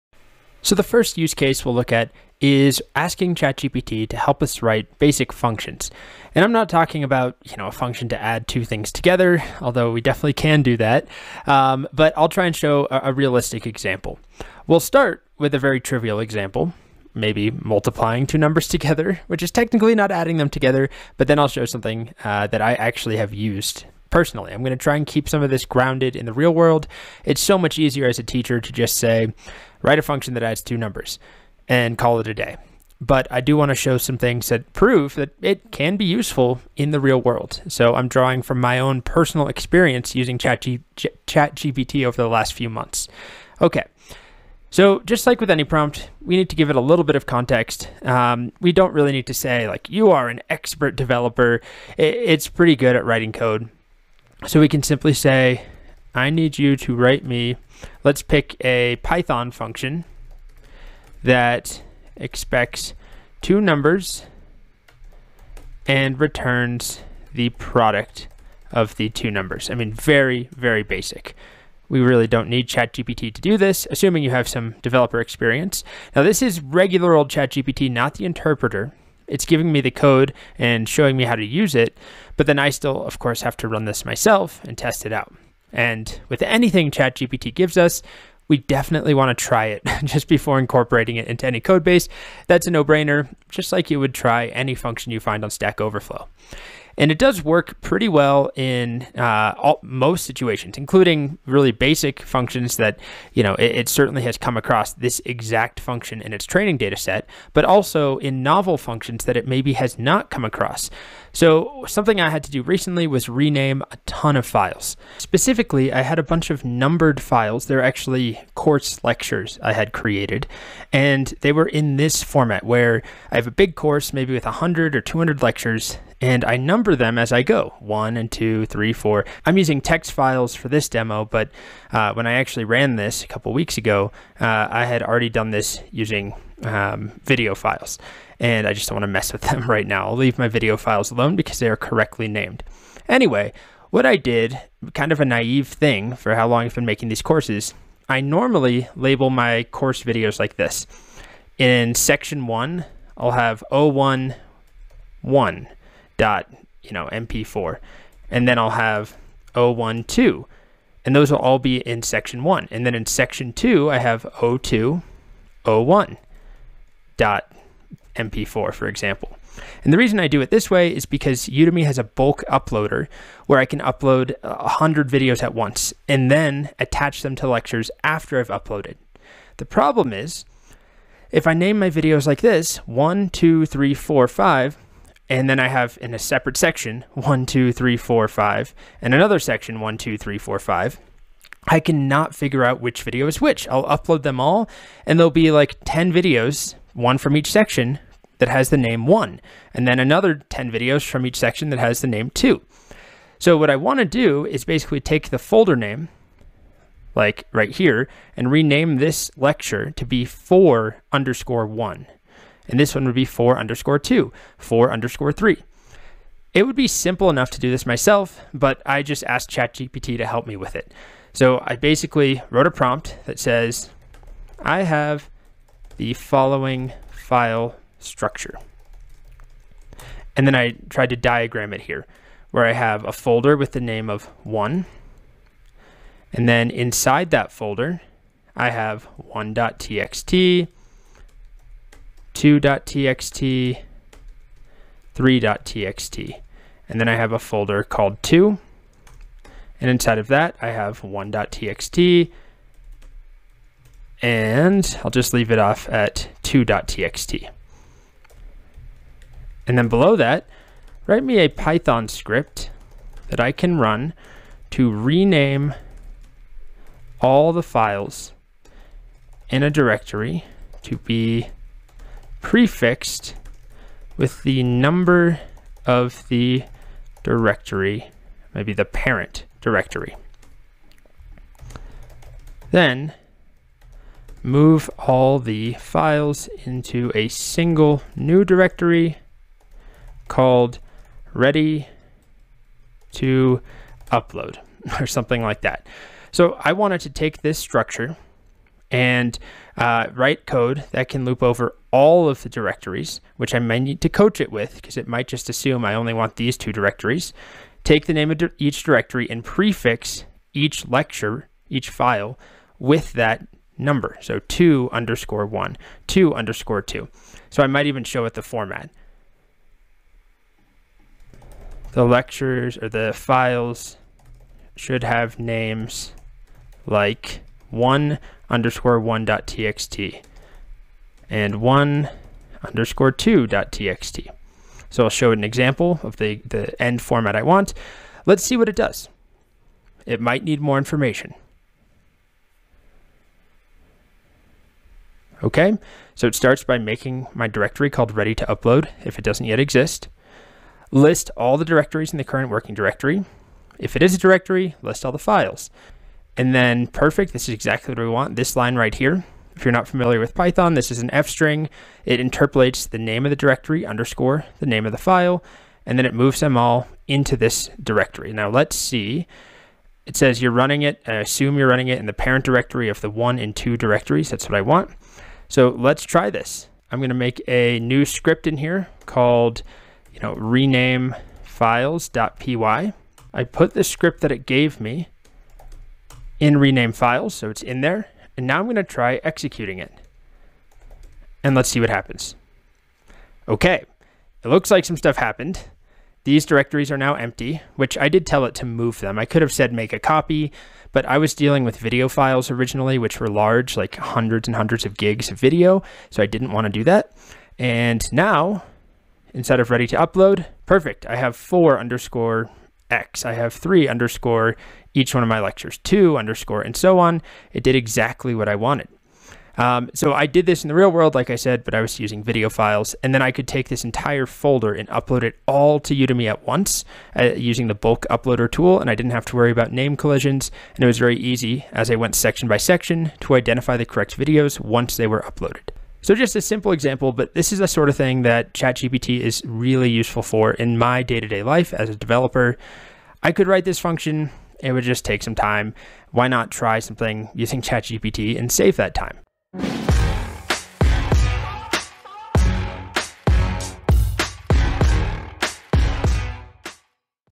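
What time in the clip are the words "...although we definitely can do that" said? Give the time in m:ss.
0:09.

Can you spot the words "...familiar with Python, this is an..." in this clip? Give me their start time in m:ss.
5:59.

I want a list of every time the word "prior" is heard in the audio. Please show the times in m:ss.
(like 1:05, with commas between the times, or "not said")
not said.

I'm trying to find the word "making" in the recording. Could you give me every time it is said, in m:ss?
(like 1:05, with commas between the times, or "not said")
2:26, 5:46.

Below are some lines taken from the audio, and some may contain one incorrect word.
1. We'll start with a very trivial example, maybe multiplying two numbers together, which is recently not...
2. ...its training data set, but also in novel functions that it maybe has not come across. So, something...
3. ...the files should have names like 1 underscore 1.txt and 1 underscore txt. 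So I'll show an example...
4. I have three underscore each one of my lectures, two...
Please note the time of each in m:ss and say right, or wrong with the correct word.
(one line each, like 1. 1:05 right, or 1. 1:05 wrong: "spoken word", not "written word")
1. 0:14 wrong: "technically", not "recently"
2. 1:46 right
3. 5:22 right
4. 6:53 right.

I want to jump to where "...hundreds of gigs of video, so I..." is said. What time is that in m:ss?
6:44.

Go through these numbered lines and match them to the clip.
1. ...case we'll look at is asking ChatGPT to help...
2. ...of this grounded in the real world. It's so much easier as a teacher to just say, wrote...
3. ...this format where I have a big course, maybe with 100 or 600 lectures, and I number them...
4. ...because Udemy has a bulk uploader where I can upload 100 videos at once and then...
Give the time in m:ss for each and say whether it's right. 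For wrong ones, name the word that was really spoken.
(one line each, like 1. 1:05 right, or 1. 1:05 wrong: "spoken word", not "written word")
1. 0:01 right
2. 0:25 wrong: "write", not "wrote"
3. 2:01 wrong: "200", not "600"
4. 2:51 right.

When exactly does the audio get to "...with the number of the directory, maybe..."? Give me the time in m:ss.
4:34.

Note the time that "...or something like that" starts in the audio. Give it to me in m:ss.
4:55.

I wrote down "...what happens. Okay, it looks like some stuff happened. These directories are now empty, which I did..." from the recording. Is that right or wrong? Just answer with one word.
right.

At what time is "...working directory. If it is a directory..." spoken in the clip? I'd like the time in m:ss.
5:52.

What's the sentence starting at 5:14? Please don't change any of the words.
So 2 underscore 1, 2 underscore 2.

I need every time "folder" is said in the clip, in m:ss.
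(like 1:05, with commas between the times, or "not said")
3:25, 3:53, 3:57, 4:07, 7:04.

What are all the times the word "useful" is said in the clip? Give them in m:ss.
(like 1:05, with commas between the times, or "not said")
0:36, 7:19.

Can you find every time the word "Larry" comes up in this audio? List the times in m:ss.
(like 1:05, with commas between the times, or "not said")
not said.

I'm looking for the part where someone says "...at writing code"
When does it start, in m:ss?
0:52.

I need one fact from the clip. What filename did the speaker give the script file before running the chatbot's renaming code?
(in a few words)
rename files.py.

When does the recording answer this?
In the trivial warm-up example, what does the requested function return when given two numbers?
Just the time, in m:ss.
1:07.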